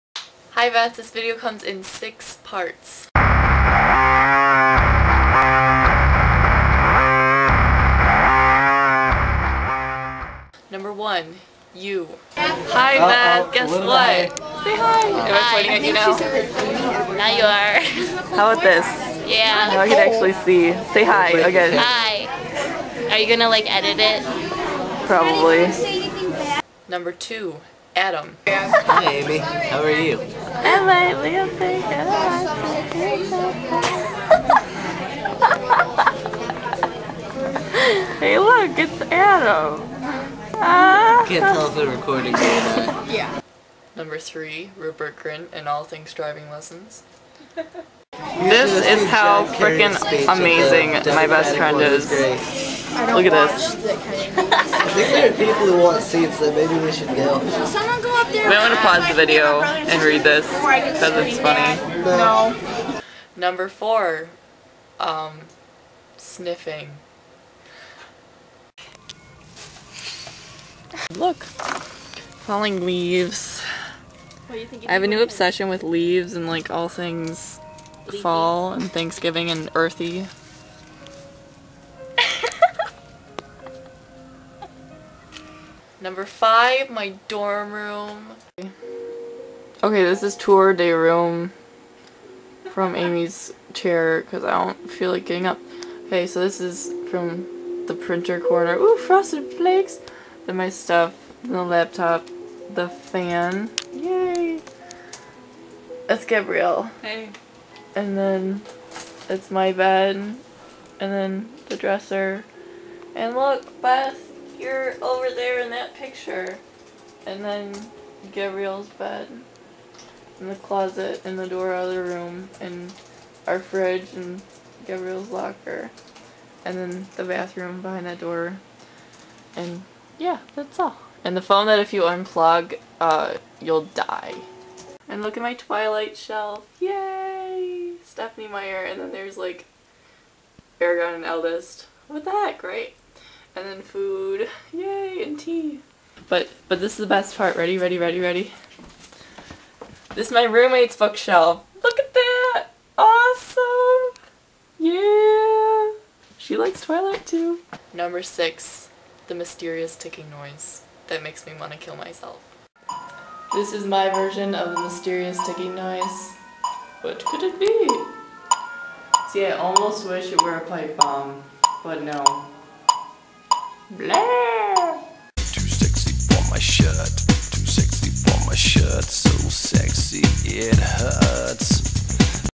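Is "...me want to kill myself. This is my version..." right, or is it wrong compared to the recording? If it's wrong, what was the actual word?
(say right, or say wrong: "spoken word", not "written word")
right.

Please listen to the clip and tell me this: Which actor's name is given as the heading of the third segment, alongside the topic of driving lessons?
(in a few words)
Rupert Grint.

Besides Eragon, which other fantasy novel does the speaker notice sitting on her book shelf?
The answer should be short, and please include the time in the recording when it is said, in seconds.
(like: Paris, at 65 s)
Eldest, at 141 s.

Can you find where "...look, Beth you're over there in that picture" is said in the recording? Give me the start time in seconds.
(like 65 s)
113 s.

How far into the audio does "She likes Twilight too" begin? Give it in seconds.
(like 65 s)
156 s.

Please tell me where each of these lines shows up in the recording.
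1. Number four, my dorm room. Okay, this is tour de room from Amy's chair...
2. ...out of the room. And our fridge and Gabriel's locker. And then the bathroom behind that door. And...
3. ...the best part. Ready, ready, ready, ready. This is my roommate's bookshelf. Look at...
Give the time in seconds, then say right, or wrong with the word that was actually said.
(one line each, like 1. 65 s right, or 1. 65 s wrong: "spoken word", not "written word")
1. 86 s wrong: "five", not "four"
2. 121 s right
3. 146 s right.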